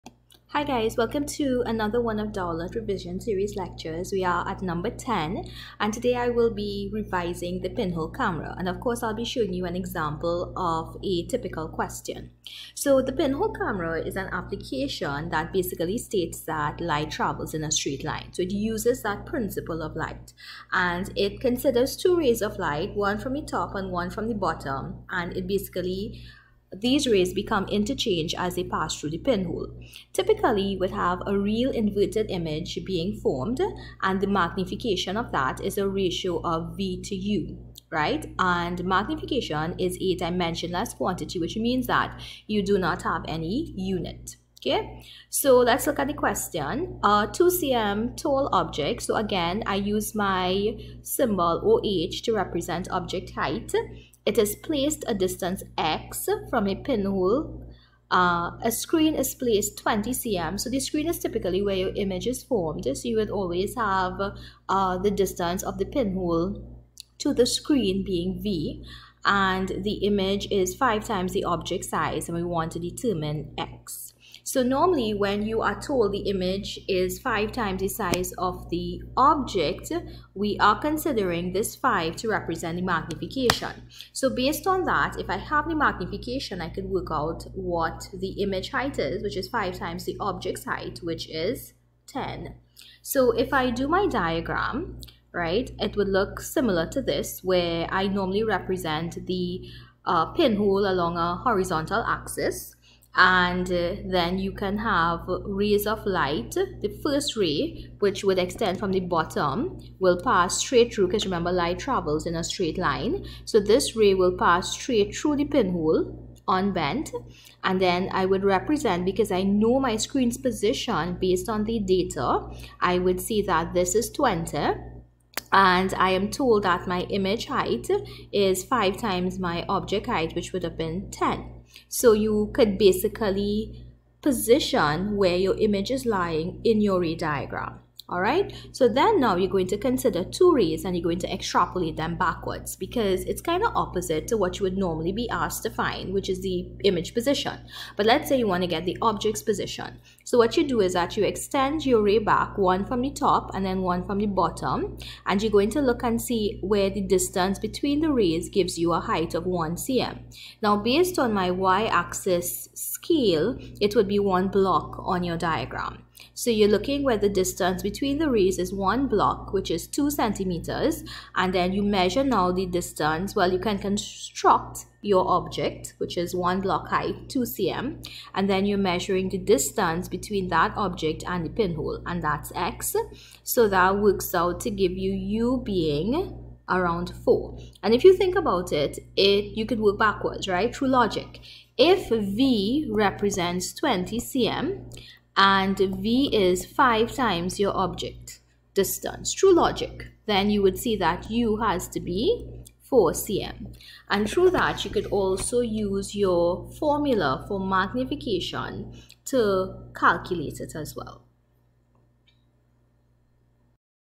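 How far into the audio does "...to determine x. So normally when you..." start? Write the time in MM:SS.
01:12.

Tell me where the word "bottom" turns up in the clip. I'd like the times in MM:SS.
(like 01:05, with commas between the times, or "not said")
00:24, 01:49, 02:34.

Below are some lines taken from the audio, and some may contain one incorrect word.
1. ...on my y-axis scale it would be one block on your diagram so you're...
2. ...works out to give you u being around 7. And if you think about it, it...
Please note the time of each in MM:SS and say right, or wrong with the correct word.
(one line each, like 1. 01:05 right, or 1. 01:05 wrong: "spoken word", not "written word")
1. 02:41 right
2. 03:03 wrong: "4", not "7".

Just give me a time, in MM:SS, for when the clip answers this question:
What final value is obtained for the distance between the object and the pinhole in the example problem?
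03:22.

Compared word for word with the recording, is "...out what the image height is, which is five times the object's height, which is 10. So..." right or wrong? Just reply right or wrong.
right.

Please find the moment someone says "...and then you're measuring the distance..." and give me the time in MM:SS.
02:58.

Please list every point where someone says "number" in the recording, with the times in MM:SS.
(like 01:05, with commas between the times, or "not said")
00:04.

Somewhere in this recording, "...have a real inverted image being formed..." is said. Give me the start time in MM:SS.
00:30.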